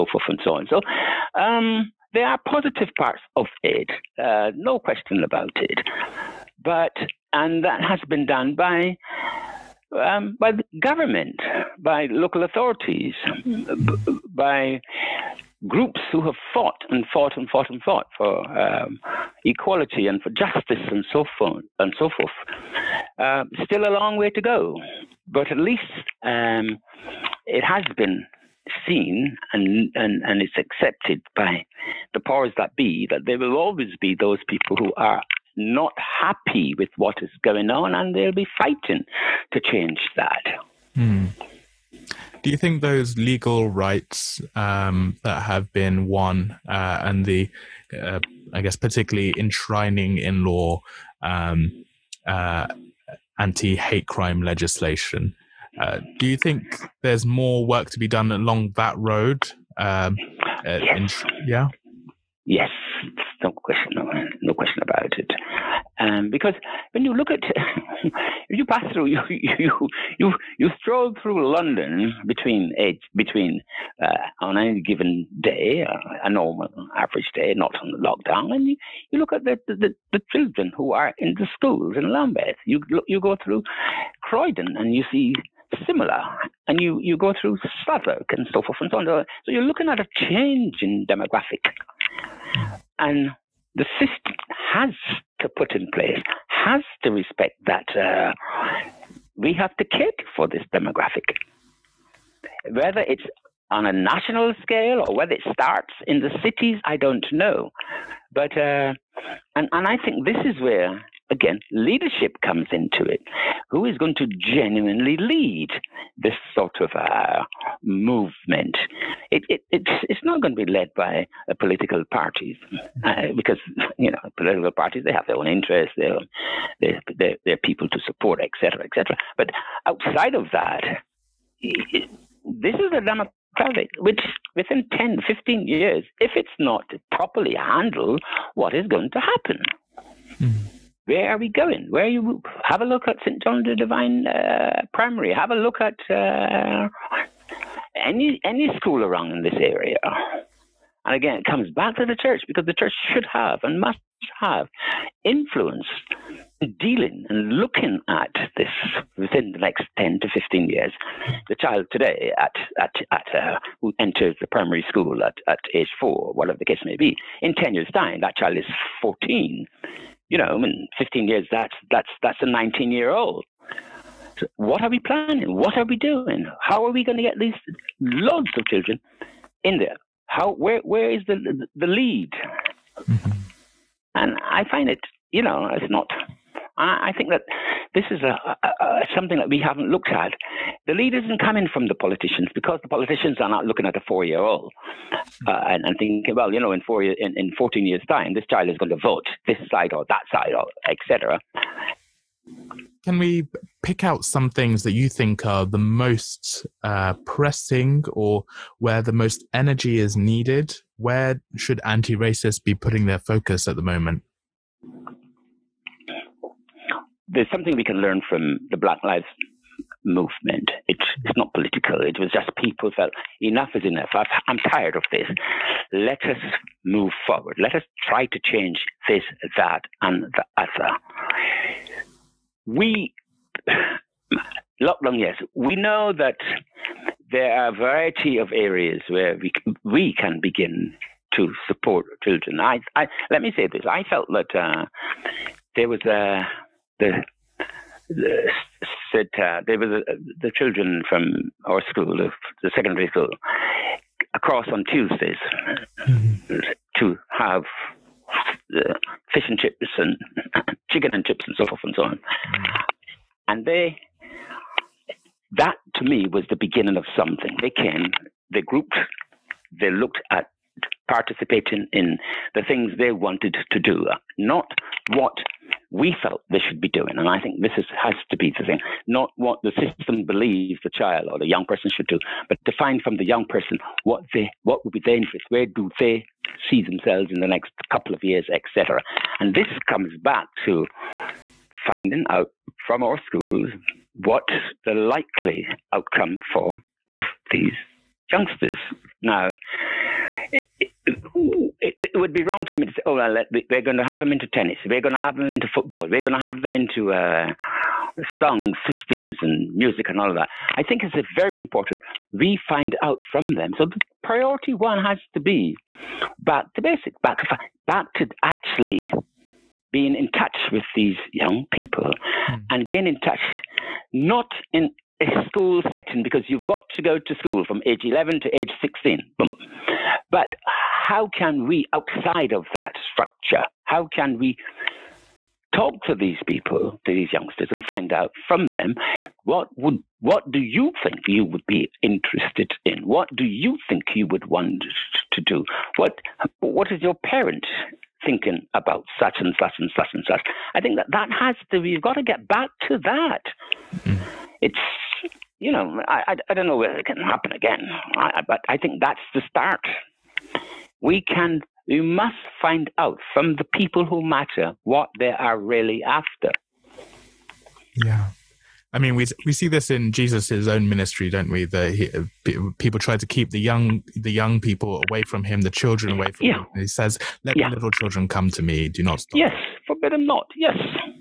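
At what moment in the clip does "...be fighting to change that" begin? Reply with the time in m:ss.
0:38.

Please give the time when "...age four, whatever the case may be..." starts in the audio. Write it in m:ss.
2:45.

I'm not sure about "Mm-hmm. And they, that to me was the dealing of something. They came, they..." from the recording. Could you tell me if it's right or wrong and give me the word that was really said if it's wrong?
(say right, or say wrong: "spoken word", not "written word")
wrong: "beginning", not "dealing".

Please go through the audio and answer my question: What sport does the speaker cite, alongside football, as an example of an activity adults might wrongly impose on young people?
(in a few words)
Tennis.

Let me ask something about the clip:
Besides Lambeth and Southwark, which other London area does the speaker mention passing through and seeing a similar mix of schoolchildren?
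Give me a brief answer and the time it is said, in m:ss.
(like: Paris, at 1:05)
Croydon, at 1:24.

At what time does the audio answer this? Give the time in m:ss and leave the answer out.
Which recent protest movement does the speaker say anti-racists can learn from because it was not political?
3:38.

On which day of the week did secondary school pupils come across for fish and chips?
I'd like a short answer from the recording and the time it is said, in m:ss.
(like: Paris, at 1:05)
Tuesdays, at 4:14.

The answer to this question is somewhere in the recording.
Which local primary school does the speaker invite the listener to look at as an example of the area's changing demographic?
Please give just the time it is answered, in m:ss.
2:23.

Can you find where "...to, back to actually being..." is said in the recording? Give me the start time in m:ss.
5:17.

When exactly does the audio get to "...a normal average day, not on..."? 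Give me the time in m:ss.
1:16.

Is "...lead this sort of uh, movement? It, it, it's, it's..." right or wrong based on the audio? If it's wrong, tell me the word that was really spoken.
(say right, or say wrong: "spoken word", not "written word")
right.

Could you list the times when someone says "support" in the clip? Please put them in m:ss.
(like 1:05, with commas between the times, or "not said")
2:08, 4:01.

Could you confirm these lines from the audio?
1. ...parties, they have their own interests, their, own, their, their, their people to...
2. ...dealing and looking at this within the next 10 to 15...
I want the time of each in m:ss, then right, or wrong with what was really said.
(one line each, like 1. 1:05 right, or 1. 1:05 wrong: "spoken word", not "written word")
1. 2:04 right
2. 2:36 right.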